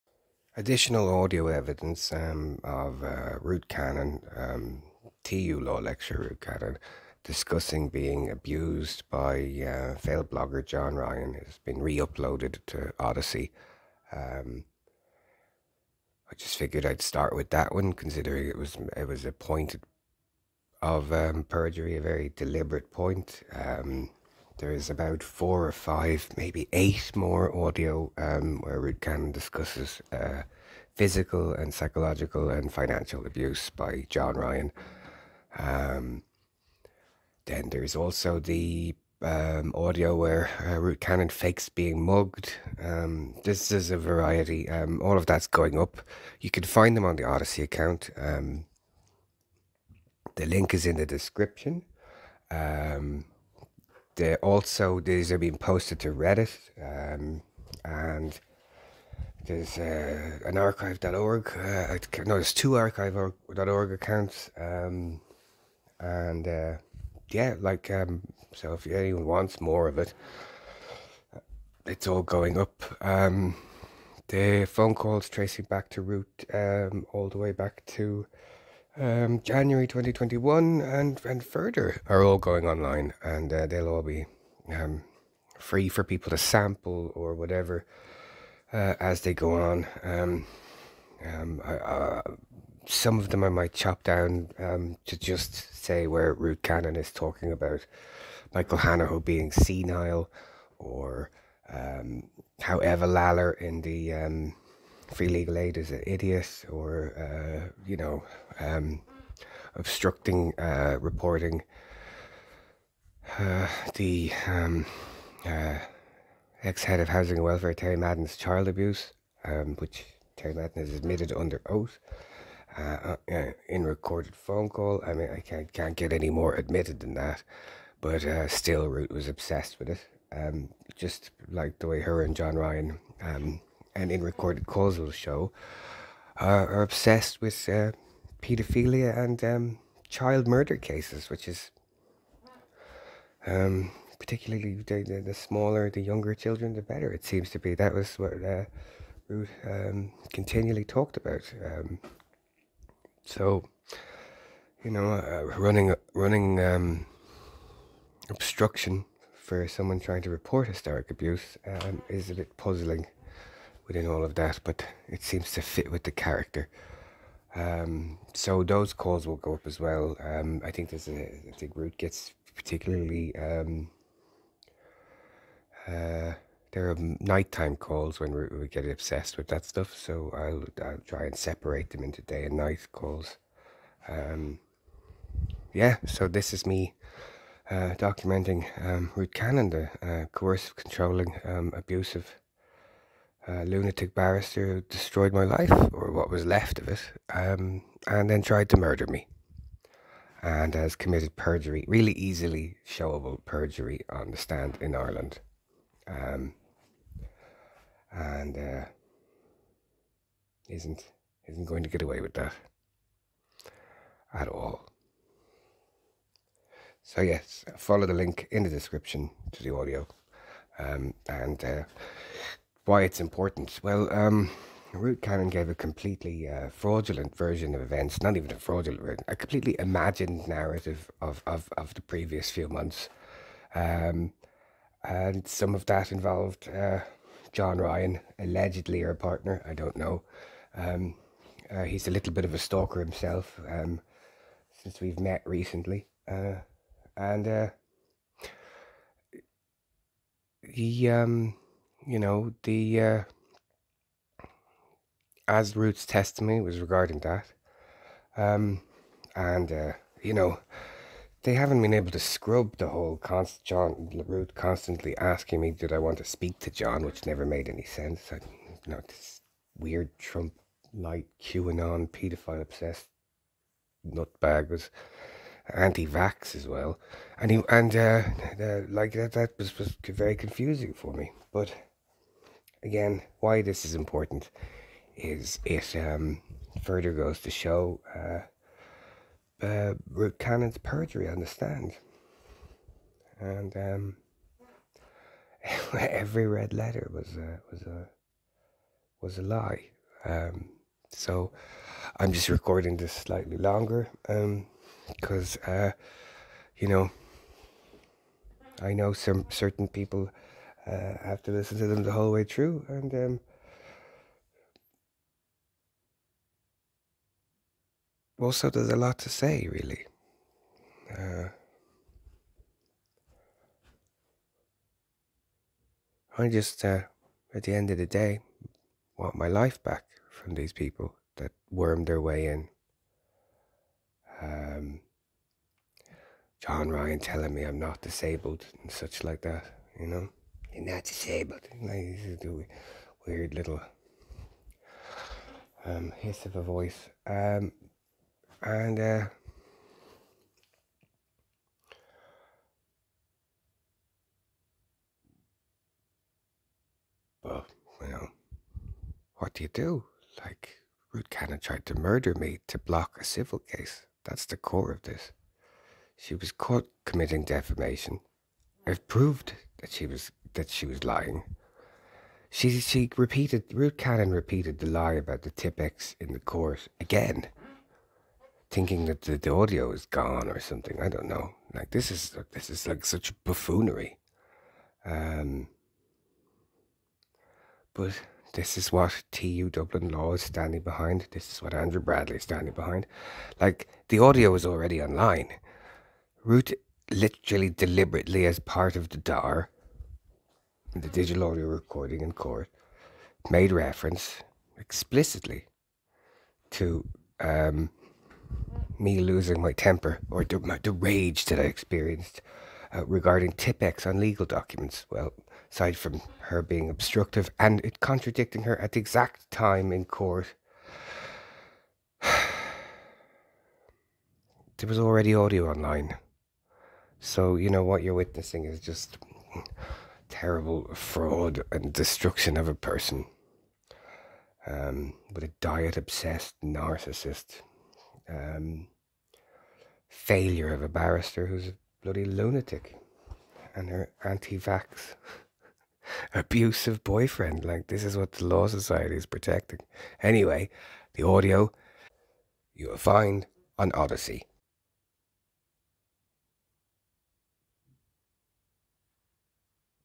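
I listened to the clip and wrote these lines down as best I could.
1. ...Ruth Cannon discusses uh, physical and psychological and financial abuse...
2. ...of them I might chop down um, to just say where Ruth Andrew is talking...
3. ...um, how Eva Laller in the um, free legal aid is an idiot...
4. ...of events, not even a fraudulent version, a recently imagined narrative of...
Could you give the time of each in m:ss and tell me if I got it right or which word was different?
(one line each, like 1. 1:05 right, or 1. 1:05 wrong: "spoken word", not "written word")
1. 0:28 right
2. 1:33 wrong: "Cannon", not "Andrew"
3. 1:41 right
4. 3:47 wrong: "completely", not "recently".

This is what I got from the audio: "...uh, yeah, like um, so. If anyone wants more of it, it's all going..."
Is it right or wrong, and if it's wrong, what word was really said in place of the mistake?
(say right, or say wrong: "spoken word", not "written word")
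right.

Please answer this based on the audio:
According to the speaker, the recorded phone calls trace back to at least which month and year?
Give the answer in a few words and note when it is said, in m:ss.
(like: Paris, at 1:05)
January 2021, at 1:19.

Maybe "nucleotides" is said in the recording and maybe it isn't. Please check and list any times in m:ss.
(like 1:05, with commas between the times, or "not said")
not said.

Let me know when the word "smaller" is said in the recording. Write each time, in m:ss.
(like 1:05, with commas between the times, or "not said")
2:25.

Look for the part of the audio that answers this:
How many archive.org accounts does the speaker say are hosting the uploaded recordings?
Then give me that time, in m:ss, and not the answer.
1:02.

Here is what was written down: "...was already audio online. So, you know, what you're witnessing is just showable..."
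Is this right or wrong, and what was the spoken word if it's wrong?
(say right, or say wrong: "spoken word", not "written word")
wrong: "terrible", not "showable".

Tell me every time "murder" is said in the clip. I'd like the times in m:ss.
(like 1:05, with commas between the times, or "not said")
2:20, 3:18, 6:01.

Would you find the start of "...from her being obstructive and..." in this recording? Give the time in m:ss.
6:55.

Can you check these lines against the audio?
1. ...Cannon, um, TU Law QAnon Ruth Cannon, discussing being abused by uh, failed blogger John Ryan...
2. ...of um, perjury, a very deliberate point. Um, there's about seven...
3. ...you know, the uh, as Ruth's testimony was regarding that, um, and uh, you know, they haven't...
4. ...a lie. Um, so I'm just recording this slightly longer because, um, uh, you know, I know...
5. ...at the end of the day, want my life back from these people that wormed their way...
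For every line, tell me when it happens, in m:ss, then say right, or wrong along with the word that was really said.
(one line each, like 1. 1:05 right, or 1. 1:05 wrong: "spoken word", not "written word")
1. 0:03 wrong: "Lecture", not "QAnon"
2. 0:20 wrong: "four", not "seven"
3. 4:12 right
4. 4:59 right
5. 5:27 right.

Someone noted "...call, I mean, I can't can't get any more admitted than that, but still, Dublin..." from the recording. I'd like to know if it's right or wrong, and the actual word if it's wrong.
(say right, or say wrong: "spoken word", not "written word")
wrong: "Ruth", not "Dublin".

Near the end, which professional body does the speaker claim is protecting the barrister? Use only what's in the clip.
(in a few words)
The Law Society.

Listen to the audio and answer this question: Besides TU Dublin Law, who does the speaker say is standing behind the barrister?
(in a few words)
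Andrew Bradley.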